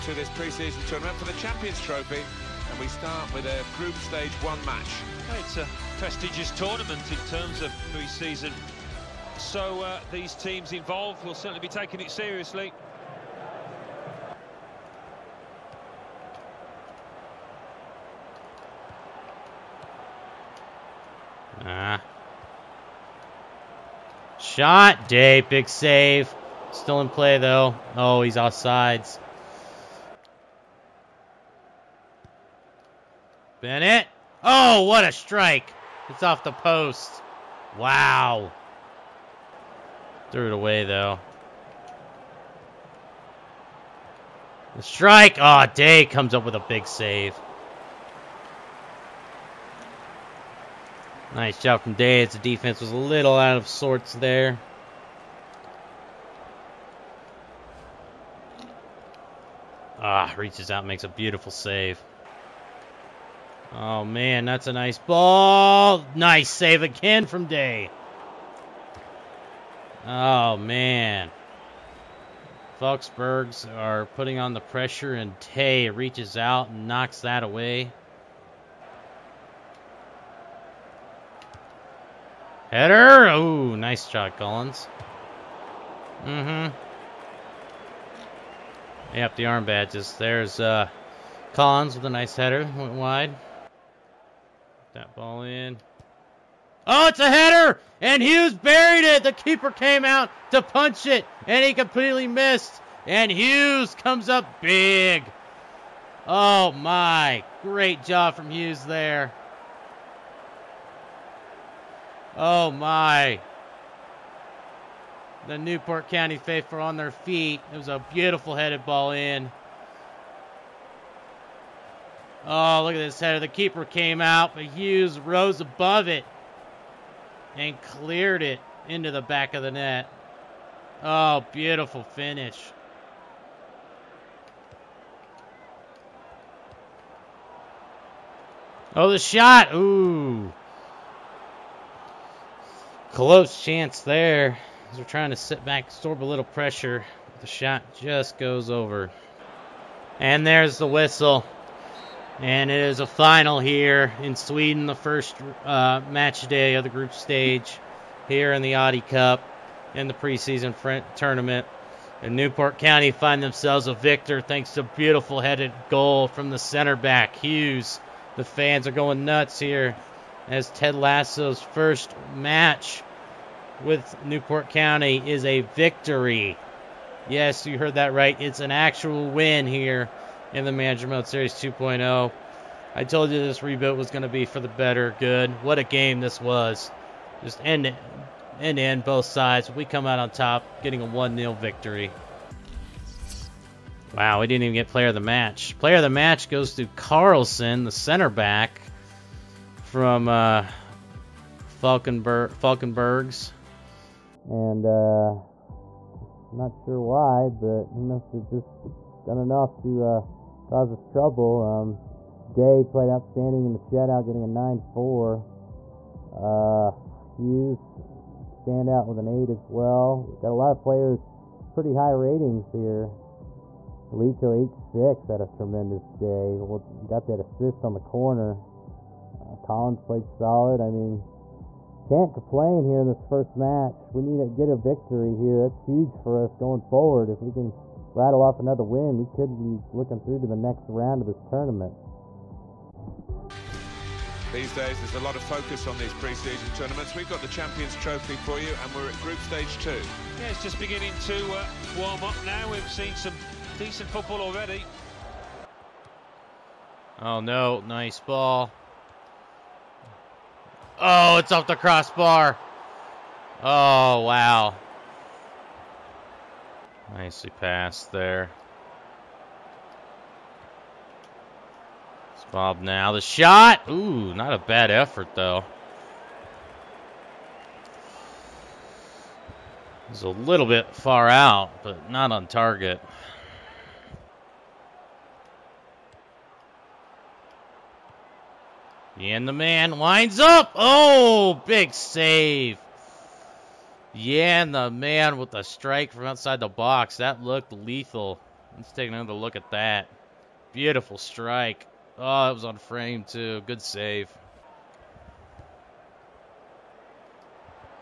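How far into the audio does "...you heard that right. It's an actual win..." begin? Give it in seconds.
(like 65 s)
177 s.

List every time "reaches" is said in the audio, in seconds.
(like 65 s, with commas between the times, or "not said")
60 s, 75 s.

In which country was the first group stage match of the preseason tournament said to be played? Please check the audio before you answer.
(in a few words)
Sweden.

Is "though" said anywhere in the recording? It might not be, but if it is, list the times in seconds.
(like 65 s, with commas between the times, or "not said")
27 s, 40 s, 275 s.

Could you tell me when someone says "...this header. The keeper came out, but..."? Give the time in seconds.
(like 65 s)
122 s.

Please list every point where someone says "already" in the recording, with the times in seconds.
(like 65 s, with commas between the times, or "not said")
254 s.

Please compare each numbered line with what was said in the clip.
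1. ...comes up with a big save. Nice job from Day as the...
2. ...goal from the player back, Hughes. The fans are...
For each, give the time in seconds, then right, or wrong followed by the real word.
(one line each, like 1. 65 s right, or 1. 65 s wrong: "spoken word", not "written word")
1. 46 s right
2. 165 s wrong: "center", not "player".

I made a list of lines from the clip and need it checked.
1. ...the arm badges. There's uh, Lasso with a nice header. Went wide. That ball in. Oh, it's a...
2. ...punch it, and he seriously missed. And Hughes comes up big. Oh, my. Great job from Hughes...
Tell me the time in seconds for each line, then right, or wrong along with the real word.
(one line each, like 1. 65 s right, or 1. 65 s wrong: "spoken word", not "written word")
1. 89 s wrong: "Collins", not "Lasso"
2. 100 s wrong: "completely", not "seriously".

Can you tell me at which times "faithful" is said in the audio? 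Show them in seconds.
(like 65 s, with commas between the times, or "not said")
116 s.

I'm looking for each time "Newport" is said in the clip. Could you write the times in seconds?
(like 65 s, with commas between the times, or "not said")
115 s, 162 s, 174 s.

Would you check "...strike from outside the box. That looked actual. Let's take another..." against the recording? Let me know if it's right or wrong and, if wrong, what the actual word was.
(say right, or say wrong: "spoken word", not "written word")
wrong: "lethal", not "actual".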